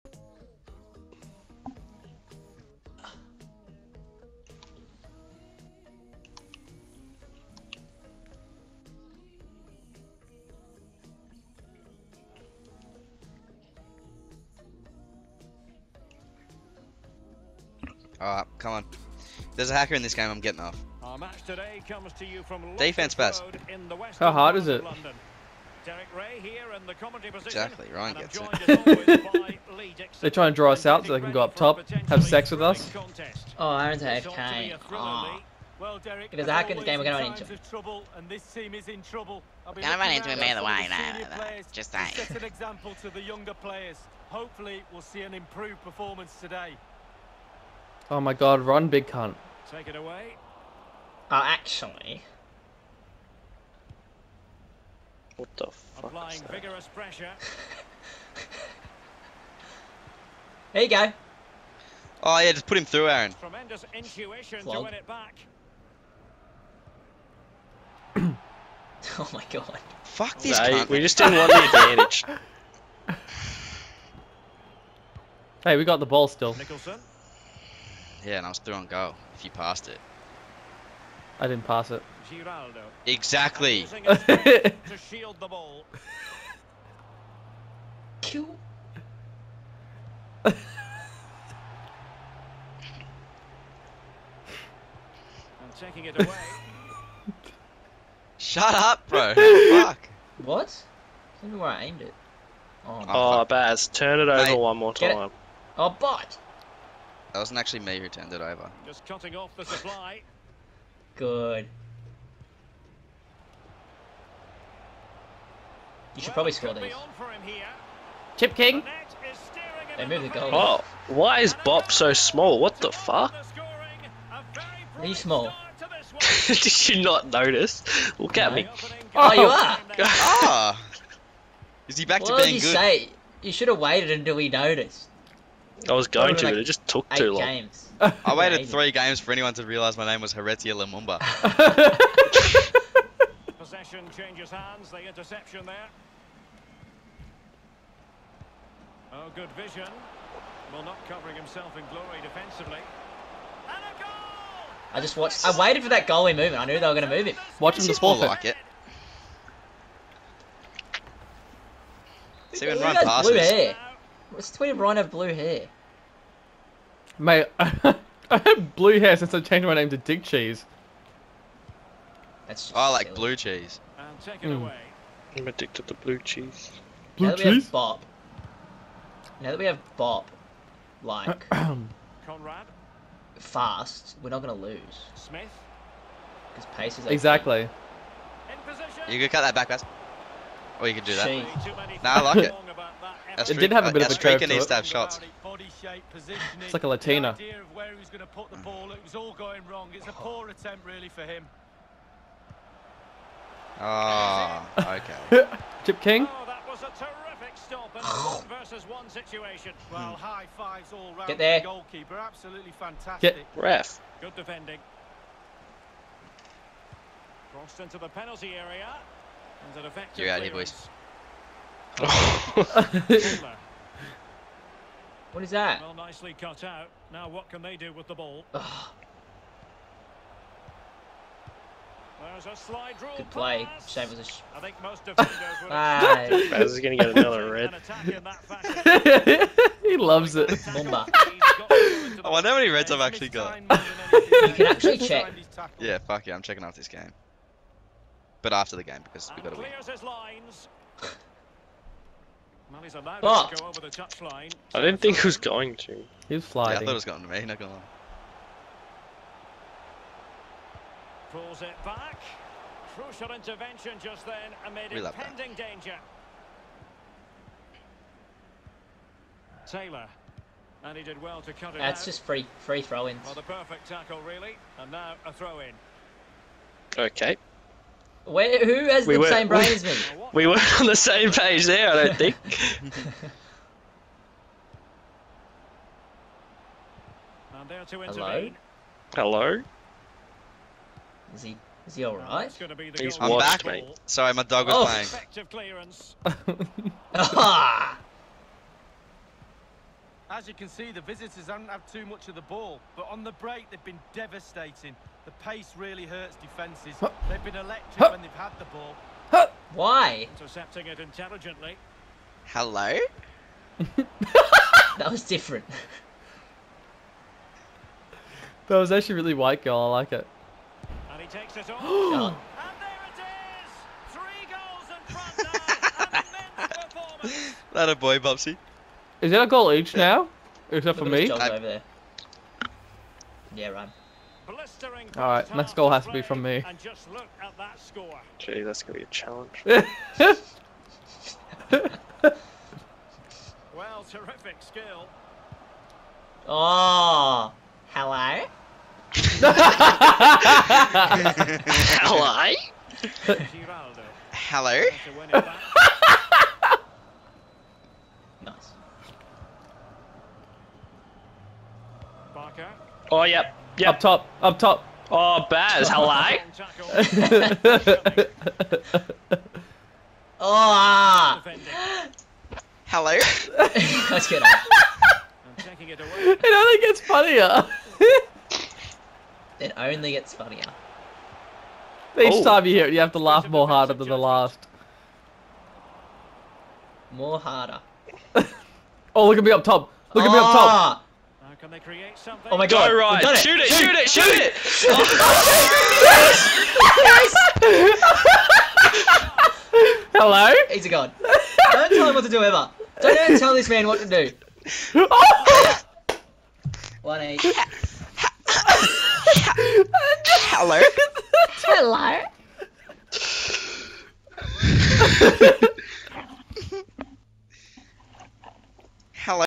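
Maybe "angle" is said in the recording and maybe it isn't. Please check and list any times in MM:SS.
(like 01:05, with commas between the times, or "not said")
not said.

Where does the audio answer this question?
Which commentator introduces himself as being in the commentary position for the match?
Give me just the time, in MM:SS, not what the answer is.
00:25.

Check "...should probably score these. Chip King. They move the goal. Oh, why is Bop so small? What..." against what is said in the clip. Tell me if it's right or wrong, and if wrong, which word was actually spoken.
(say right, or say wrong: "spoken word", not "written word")
right.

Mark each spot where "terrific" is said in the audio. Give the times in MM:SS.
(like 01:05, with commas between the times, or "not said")
03:26, 05:44.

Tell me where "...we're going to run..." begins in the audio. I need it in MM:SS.
00:36.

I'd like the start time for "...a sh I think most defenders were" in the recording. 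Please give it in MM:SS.
03:54.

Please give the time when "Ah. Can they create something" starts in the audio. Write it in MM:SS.
06:30.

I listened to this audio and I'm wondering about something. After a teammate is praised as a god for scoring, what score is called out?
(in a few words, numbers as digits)
1-8.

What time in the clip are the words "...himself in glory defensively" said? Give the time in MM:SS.
02:31.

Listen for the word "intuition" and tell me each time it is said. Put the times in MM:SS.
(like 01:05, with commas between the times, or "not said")
01:03.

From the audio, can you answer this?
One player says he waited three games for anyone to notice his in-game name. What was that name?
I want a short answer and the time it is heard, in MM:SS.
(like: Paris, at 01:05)
Heretia Lumumba, at 02:20.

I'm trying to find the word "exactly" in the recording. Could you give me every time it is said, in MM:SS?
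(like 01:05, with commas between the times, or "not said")
00:27, 01:23, 03:07.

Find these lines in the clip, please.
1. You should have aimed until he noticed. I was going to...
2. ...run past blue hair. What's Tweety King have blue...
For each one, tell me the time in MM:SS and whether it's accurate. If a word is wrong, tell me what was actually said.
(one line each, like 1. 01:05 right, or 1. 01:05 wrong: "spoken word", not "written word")
1. 02:13 wrong: "waited", not "aimed"
2. 02:42 wrong: "Brown", not "King".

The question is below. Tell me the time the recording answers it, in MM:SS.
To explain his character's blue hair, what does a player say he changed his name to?
02:49.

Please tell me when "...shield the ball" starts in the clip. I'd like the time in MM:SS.
01:25.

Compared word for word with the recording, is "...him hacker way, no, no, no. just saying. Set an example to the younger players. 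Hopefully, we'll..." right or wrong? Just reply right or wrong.
wrong.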